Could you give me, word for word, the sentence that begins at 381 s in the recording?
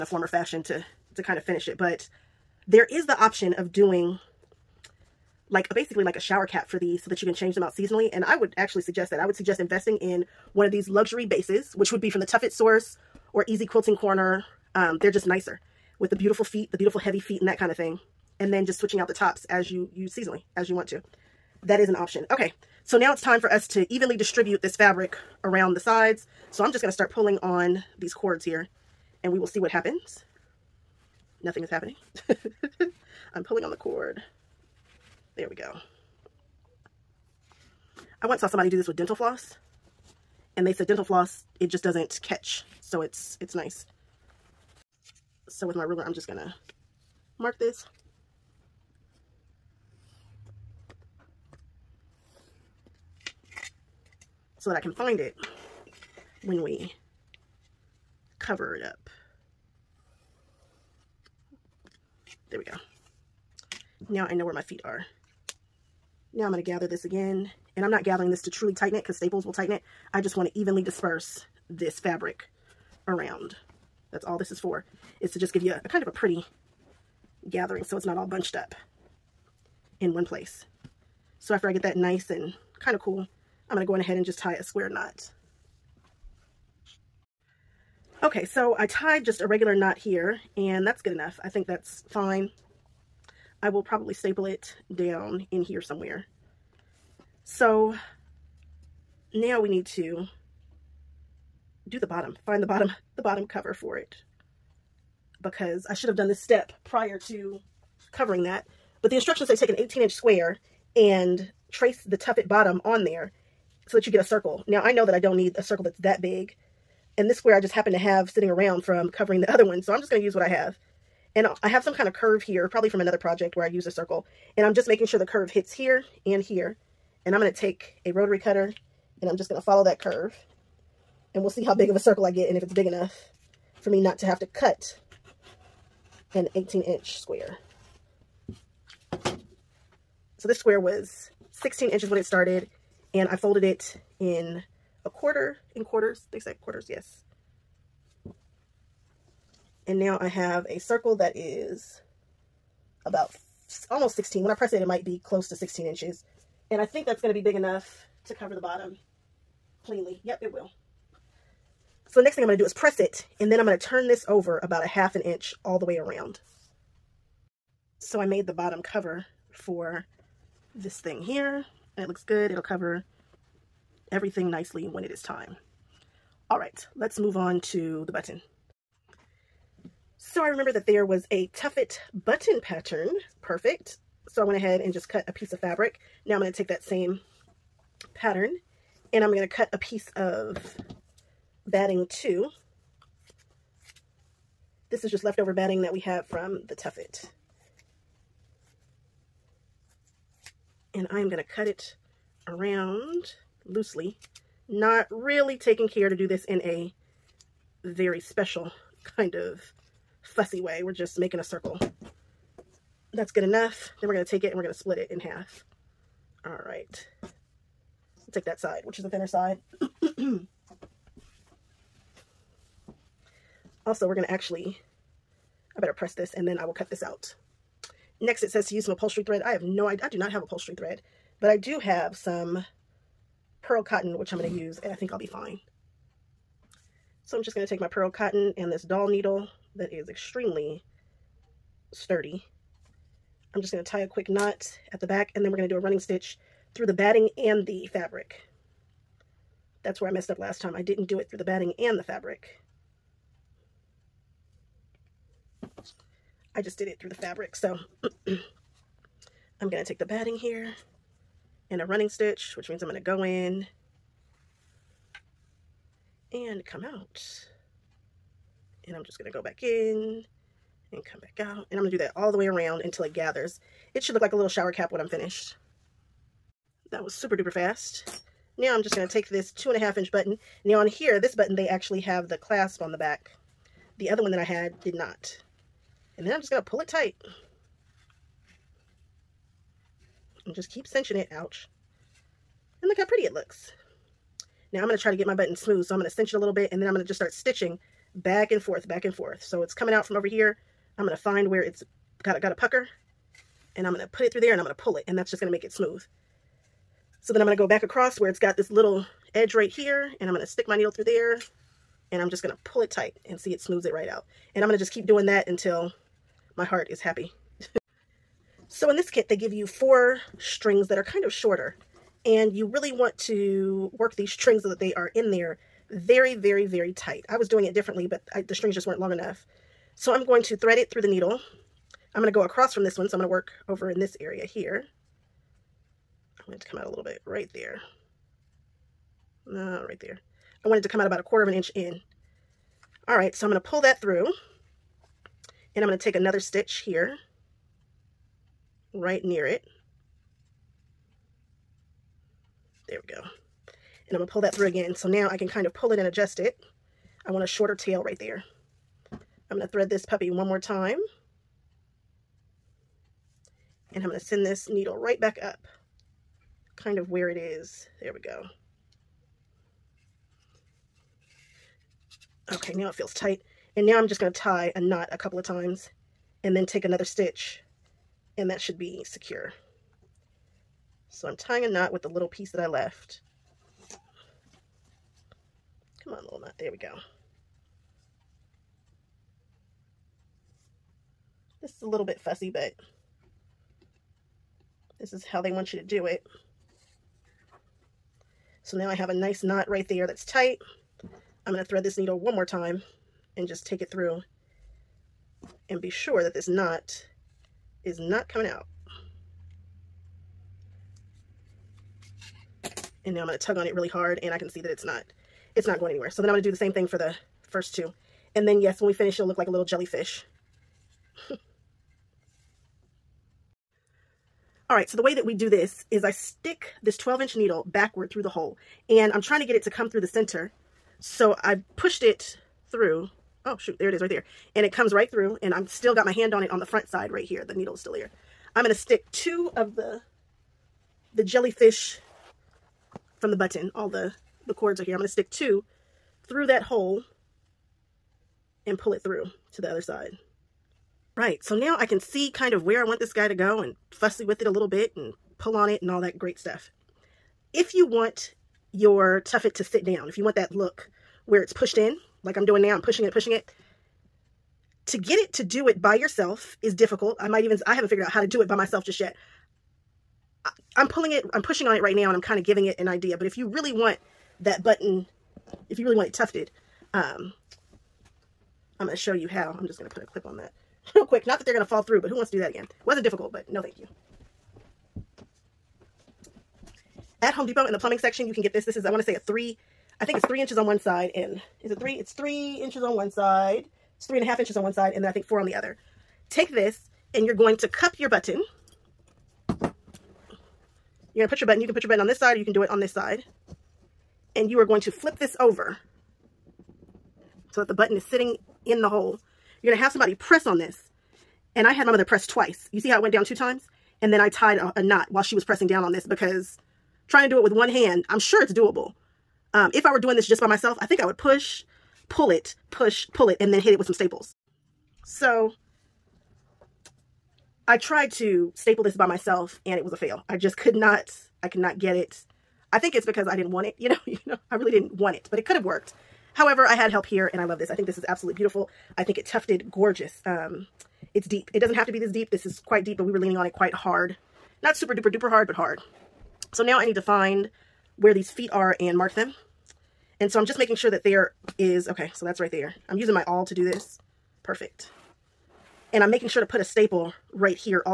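So I'm tying a knot with the little piece that I left.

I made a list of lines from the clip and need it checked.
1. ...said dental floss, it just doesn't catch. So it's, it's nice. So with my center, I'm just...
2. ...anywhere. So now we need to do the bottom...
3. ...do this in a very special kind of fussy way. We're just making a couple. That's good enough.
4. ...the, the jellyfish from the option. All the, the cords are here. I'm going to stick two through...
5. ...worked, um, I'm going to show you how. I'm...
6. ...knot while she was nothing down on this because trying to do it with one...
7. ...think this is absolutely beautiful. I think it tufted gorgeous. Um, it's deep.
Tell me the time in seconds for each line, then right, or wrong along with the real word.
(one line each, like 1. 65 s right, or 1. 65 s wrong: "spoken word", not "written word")
1. 40 s wrong: "ruler", not "center"
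2. 95 s wrong: "somewhere", not "anywhere"
3. 206 s wrong: "circle", not "couple"
4. 439 s wrong: "button", not "option"
5. 476 s wrong: "tufted", not "worked"
6. 514 s wrong: "pressing", not "nothing"
7. 537 s right.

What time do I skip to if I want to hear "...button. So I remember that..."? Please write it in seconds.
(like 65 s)
178 s.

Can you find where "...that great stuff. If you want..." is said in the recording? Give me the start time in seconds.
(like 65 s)
456 s.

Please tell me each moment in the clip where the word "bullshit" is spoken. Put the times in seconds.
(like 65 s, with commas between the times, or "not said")
not said.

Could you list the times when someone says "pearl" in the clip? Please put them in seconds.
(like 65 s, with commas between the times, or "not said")
233 s, 237 s.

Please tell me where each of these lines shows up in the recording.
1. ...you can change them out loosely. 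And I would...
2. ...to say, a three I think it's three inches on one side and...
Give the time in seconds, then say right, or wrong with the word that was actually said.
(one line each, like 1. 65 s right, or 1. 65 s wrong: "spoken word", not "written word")
1. 7 s wrong: "seasonally", not "loosely"
2. 488 s right.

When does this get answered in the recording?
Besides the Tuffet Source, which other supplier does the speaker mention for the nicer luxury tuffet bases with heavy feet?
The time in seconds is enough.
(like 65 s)
13 s.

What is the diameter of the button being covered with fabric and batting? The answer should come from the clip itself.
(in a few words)
2.5 inches.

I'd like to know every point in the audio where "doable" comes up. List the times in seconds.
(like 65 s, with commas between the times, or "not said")
518 s.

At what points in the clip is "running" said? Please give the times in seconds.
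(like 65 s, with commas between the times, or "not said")
245 s, 261 s.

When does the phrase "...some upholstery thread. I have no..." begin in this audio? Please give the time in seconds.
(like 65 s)
228 s.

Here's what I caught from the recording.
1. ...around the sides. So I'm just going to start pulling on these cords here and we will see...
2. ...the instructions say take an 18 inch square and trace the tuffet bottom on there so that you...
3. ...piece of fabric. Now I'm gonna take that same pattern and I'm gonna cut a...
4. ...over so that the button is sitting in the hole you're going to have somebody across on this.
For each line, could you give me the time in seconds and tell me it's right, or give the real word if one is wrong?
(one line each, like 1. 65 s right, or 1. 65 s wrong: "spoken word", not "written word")
1. 25 s right
2. 109 s right
3. 185 s right
4. 505 s wrong: "press", not "across".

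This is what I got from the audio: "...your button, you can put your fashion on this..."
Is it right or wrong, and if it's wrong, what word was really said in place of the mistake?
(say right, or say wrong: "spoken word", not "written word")
wrong: "button", not "fashion".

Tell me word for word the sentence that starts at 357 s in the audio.
I want a shorter tail right there.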